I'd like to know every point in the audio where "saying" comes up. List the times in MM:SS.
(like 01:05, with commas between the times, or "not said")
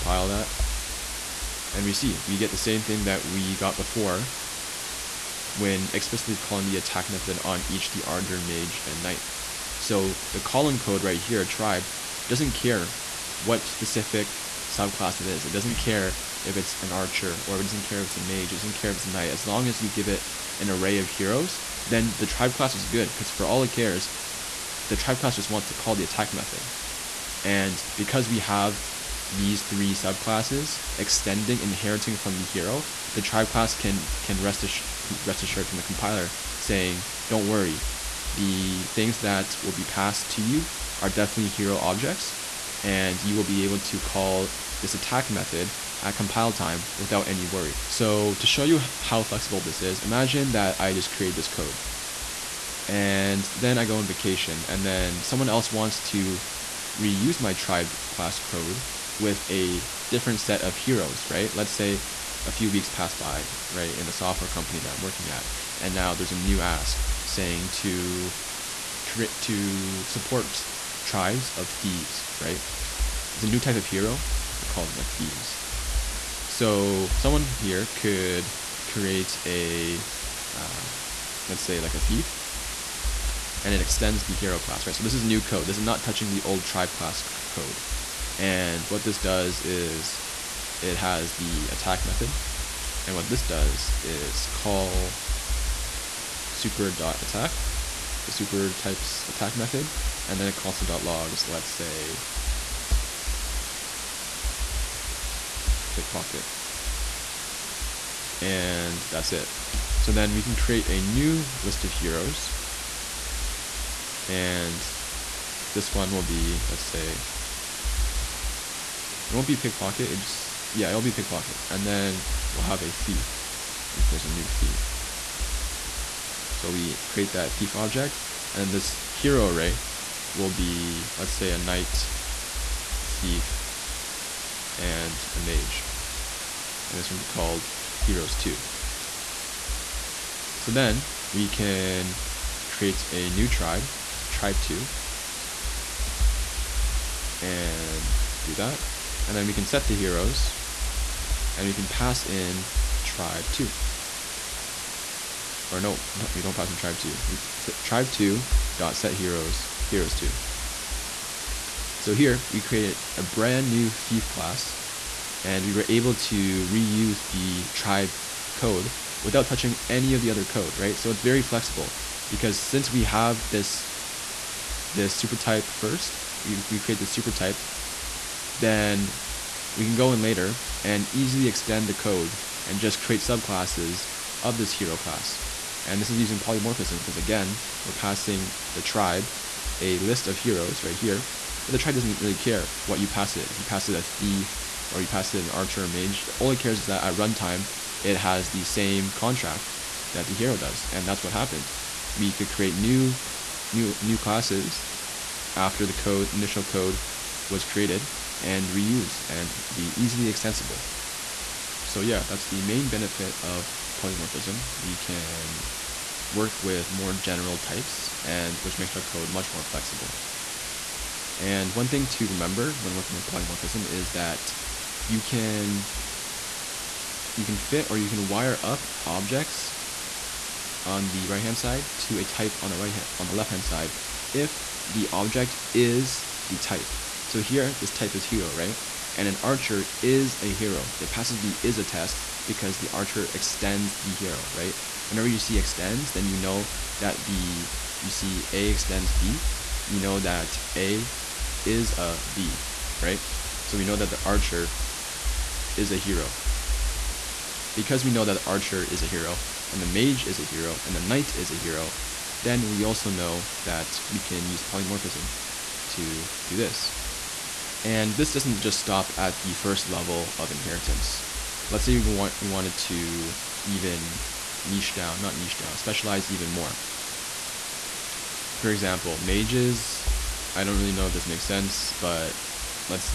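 00:36, 01:07.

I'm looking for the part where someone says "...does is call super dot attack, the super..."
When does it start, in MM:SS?
01:33.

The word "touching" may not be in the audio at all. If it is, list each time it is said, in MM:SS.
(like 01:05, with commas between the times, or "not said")
01:26, 02:49.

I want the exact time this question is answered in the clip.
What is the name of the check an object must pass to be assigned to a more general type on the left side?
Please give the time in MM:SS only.
04:01.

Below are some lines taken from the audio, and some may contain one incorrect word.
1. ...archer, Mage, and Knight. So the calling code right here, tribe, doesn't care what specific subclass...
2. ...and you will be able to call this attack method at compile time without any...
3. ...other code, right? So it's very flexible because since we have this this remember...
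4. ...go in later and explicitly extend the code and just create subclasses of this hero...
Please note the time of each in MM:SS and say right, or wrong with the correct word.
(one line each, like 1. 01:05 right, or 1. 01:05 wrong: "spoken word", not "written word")
1. 00:08 right
2. 00:42 right
3. 02:50 wrong: "super", not "remember"
4. 02:59 wrong: "easily", not "explicitly".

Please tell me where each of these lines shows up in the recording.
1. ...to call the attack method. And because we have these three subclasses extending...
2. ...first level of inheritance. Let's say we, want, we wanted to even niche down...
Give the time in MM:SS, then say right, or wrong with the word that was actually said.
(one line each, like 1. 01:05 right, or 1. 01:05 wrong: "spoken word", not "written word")
1. 00:25 right
2. 04:29 right.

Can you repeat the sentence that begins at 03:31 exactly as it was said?
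So yeah, that's the main benefit of polymorphism.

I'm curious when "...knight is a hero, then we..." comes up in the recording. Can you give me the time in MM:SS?
04:21.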